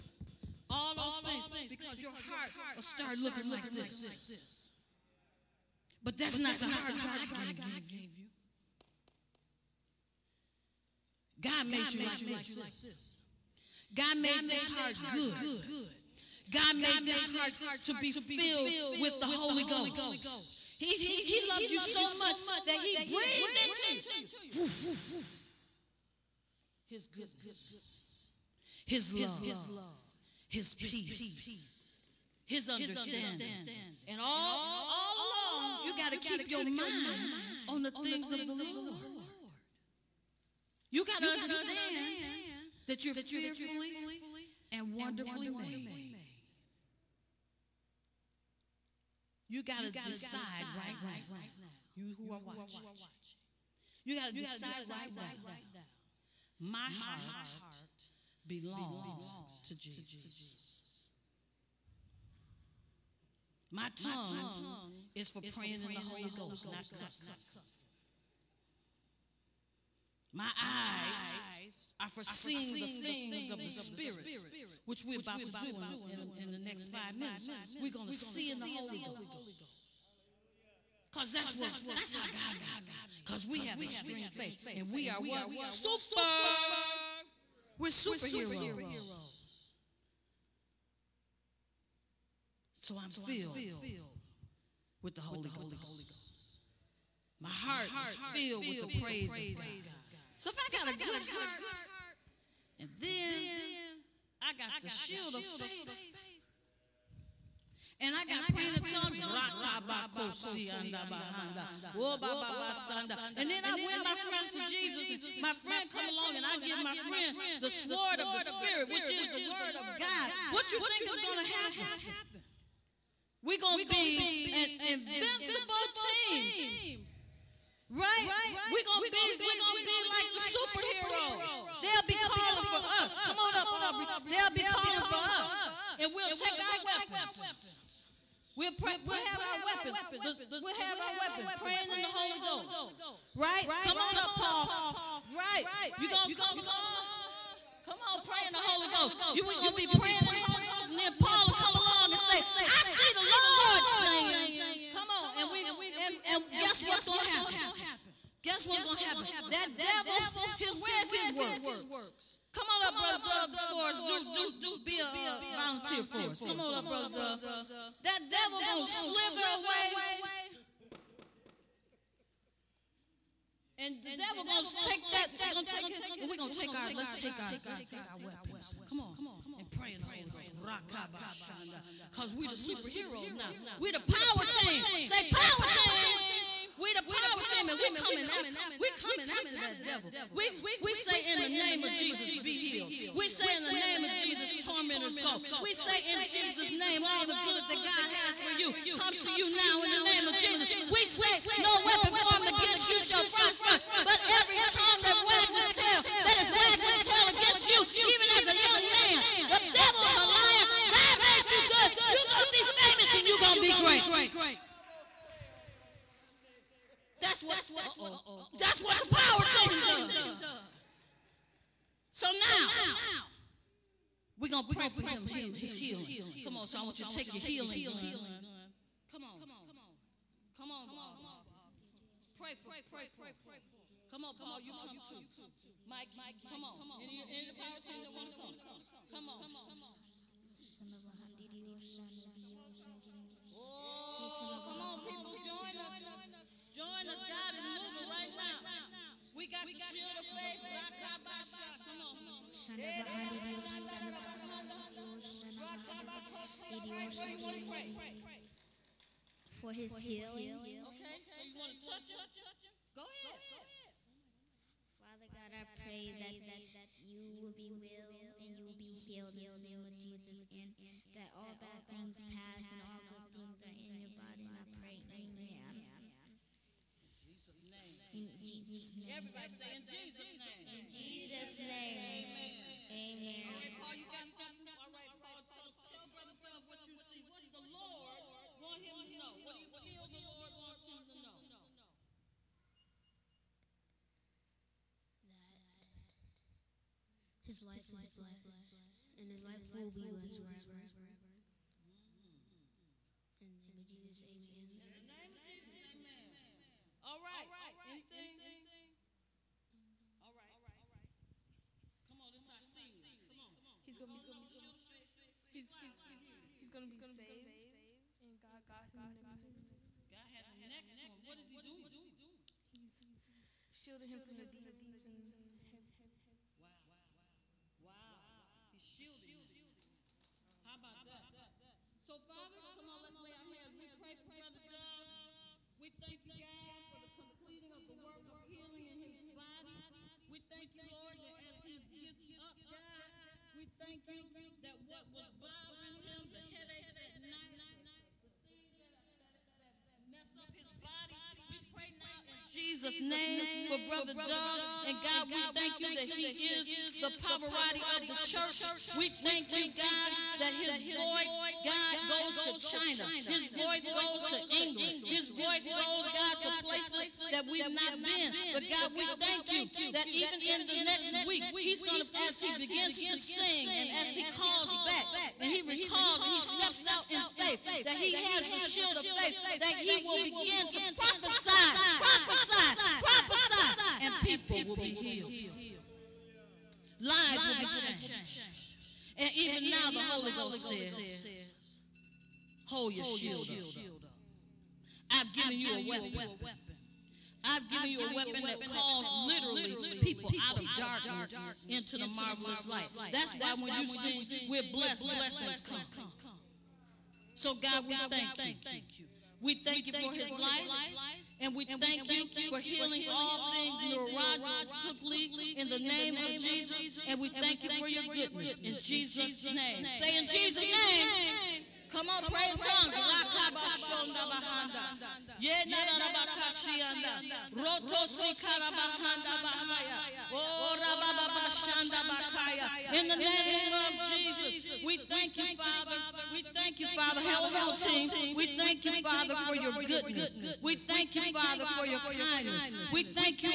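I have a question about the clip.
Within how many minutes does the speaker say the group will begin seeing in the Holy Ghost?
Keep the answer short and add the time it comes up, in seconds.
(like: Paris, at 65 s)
5, at 76 s.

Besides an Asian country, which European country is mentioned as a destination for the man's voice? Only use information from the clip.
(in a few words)
England.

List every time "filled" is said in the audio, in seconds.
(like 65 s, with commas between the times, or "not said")
18 s, 93 s, 98 s.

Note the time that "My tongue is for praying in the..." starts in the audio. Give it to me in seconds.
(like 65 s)
63 s.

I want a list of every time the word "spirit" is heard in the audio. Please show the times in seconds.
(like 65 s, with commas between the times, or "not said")
73 s, 118 s.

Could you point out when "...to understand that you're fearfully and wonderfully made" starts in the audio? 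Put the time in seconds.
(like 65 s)
41 s.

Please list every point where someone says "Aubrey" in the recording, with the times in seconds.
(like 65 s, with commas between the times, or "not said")
133 s, 230 s.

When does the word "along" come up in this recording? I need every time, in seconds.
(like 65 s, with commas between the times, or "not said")
35 s, 116 s, 146 s, 151 s.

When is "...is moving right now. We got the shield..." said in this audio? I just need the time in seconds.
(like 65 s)
247 s.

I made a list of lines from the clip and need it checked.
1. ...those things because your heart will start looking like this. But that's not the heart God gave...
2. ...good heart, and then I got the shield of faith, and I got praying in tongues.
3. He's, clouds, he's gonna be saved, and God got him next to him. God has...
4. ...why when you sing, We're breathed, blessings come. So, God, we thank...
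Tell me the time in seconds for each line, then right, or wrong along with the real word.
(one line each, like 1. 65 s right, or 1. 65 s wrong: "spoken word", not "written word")
1. 0 s right
2. 100 s right
3. 315 s right
4. 403 s wrong: "blessed", not "breathed".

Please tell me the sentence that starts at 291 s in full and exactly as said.
That his life is blessed and his life will be blessed forever.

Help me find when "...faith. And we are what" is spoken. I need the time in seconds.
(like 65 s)
84 s.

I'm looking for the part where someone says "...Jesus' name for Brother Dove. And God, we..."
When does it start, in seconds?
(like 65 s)
352 s.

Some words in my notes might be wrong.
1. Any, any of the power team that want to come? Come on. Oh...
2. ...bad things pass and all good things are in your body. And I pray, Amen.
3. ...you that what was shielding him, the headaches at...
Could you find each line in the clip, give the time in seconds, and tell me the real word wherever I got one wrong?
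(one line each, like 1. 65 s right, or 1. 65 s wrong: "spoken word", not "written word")
1. 237 s right
2. 271 s right
3. 344 s wrong: "bothering", not "shielding".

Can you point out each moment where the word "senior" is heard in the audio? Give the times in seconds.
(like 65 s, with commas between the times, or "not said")
312 s.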